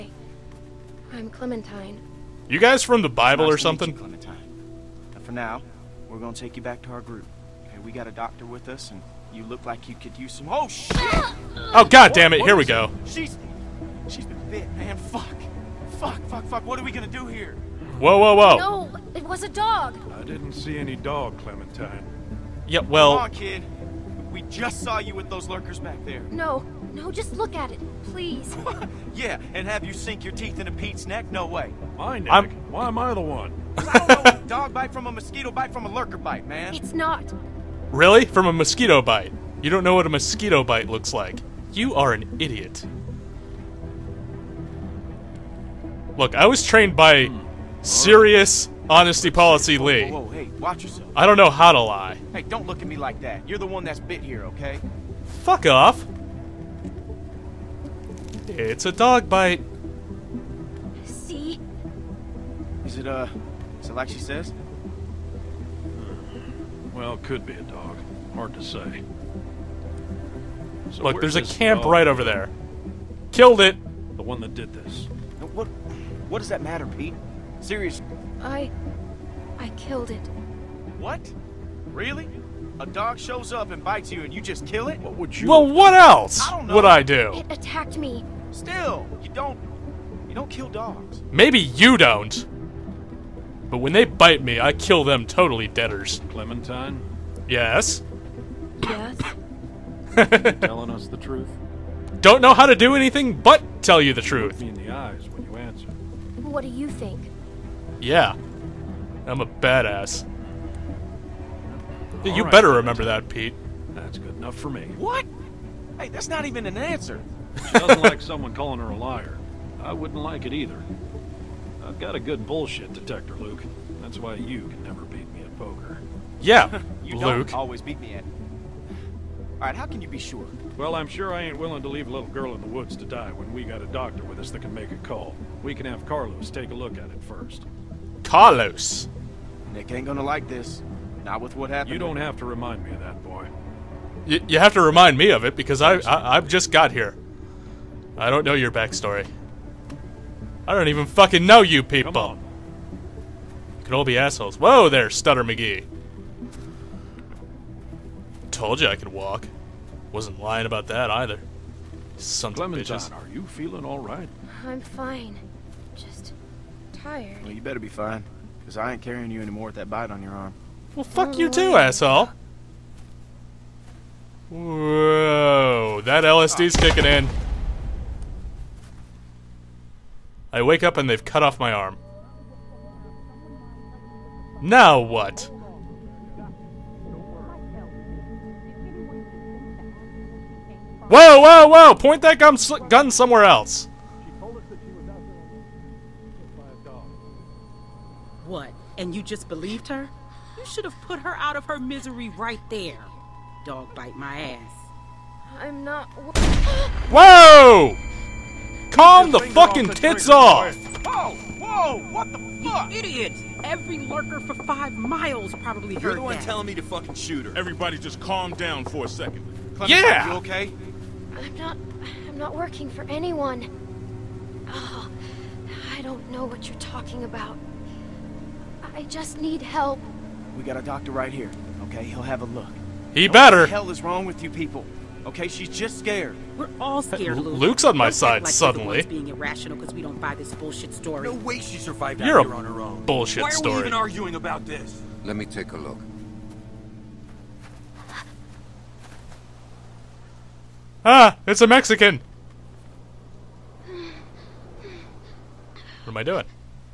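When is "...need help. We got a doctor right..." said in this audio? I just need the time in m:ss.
3:49.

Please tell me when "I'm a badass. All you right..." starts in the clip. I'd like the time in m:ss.
1:49.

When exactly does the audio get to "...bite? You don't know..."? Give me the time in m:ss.
0:39.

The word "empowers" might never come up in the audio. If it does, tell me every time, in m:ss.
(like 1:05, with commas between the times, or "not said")
not said.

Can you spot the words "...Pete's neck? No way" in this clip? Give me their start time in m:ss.
0:30.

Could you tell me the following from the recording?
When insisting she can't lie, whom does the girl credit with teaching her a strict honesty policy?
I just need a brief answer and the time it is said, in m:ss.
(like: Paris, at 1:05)
Lee, at 0:49.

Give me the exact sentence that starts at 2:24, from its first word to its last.
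You, you have to remind me of it because I, I I've just got here.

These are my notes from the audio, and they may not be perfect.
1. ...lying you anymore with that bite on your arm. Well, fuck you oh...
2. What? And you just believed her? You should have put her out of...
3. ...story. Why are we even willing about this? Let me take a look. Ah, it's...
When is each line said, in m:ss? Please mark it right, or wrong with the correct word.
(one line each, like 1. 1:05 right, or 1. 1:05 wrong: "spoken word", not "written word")
1. 2:49 wrong: "carrying", not "lying"
2. 3:18 right
3. 4:03 wrong: "arguing", not "willing".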